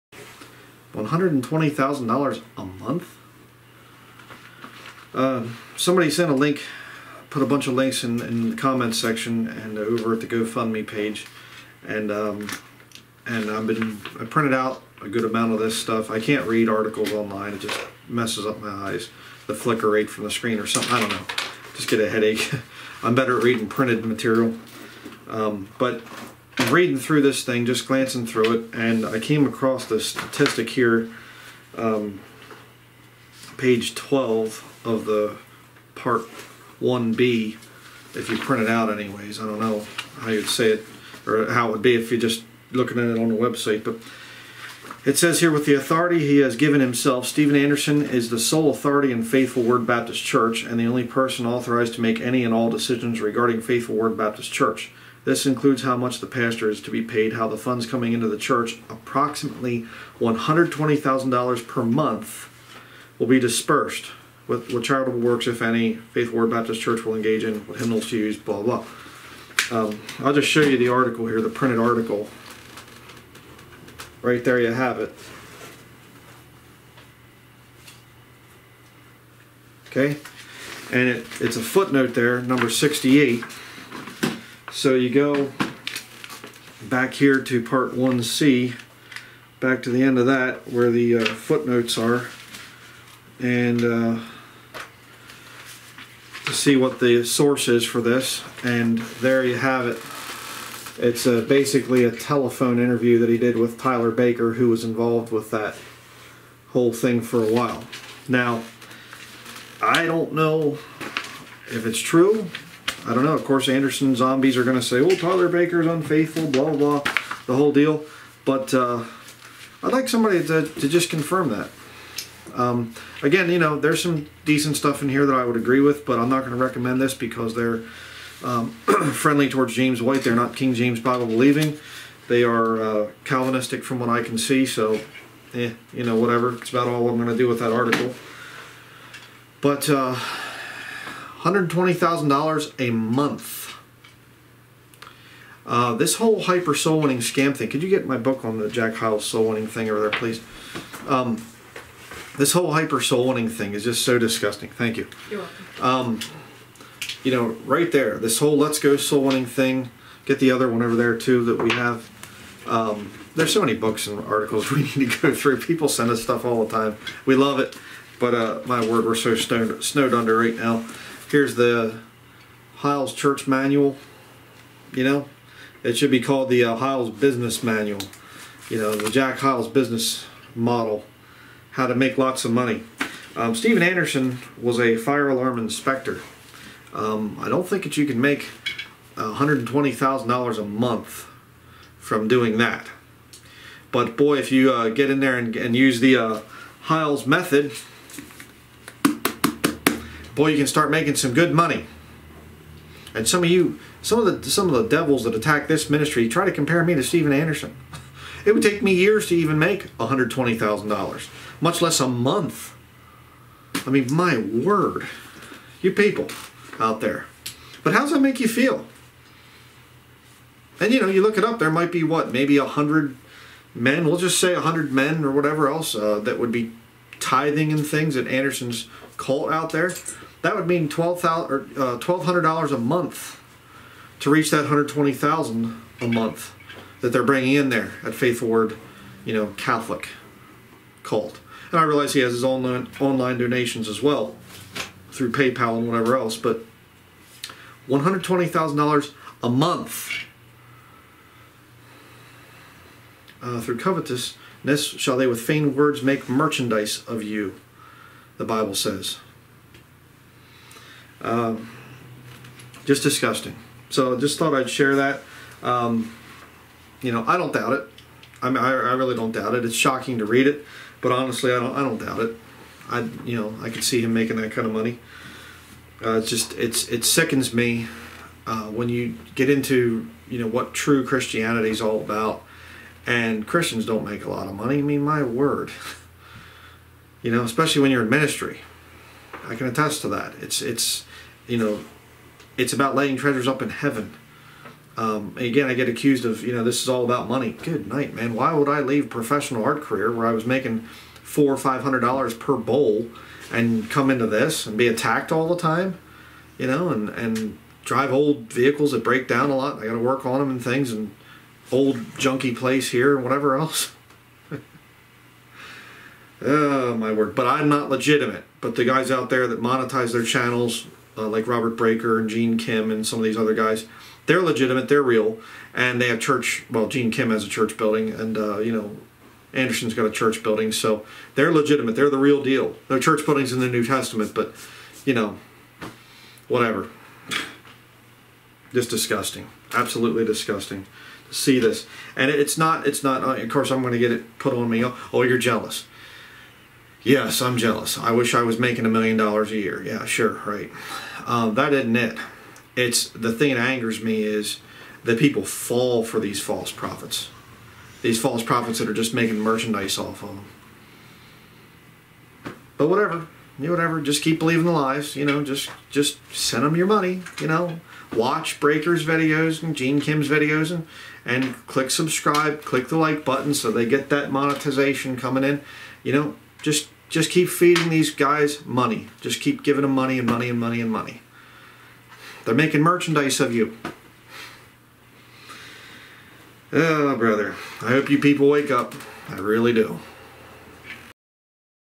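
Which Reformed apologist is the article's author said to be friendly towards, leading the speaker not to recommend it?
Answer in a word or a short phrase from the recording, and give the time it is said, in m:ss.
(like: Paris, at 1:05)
James White, at 2:09.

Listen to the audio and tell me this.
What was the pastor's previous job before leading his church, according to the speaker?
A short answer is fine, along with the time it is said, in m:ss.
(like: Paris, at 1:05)
Fire alarm inspector, at 3:04.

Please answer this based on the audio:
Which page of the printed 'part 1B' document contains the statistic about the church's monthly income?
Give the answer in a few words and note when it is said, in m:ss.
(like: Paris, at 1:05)
Page 12, at 0:33.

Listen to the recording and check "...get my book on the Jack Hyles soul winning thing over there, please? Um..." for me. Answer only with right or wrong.
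right.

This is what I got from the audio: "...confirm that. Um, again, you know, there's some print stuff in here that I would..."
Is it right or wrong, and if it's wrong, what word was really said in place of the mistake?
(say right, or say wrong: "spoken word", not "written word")
wrong: "decent", not "print".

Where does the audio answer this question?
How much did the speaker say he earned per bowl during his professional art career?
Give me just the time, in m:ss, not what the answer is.
5:01.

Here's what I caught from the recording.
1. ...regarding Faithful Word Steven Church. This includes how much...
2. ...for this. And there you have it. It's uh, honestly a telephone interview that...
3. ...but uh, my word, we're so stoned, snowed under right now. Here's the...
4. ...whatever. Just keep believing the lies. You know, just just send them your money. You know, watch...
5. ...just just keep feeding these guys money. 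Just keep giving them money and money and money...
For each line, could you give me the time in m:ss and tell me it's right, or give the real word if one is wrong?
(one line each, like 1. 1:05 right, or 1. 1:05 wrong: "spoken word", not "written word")
1. 0:53 wrong: "Baptist", not "Steven"
2. 1:37 wrong: "basically", not "honestly"
3. 2:48 right
4. 6:03 right
5. 6:16 right.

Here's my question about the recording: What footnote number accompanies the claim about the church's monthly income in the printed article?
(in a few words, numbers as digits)
68.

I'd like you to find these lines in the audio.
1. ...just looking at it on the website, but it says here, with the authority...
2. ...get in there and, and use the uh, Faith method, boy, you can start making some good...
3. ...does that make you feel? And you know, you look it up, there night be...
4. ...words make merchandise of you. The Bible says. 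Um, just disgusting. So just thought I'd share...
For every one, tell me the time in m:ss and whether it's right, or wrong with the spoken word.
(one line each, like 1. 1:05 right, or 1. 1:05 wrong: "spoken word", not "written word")
1. 0:42 right
2. 3:14 wrong: "Hyles", not "Faith"
3. 3:37 wrong: "might", not "night"
4. 4:15 right.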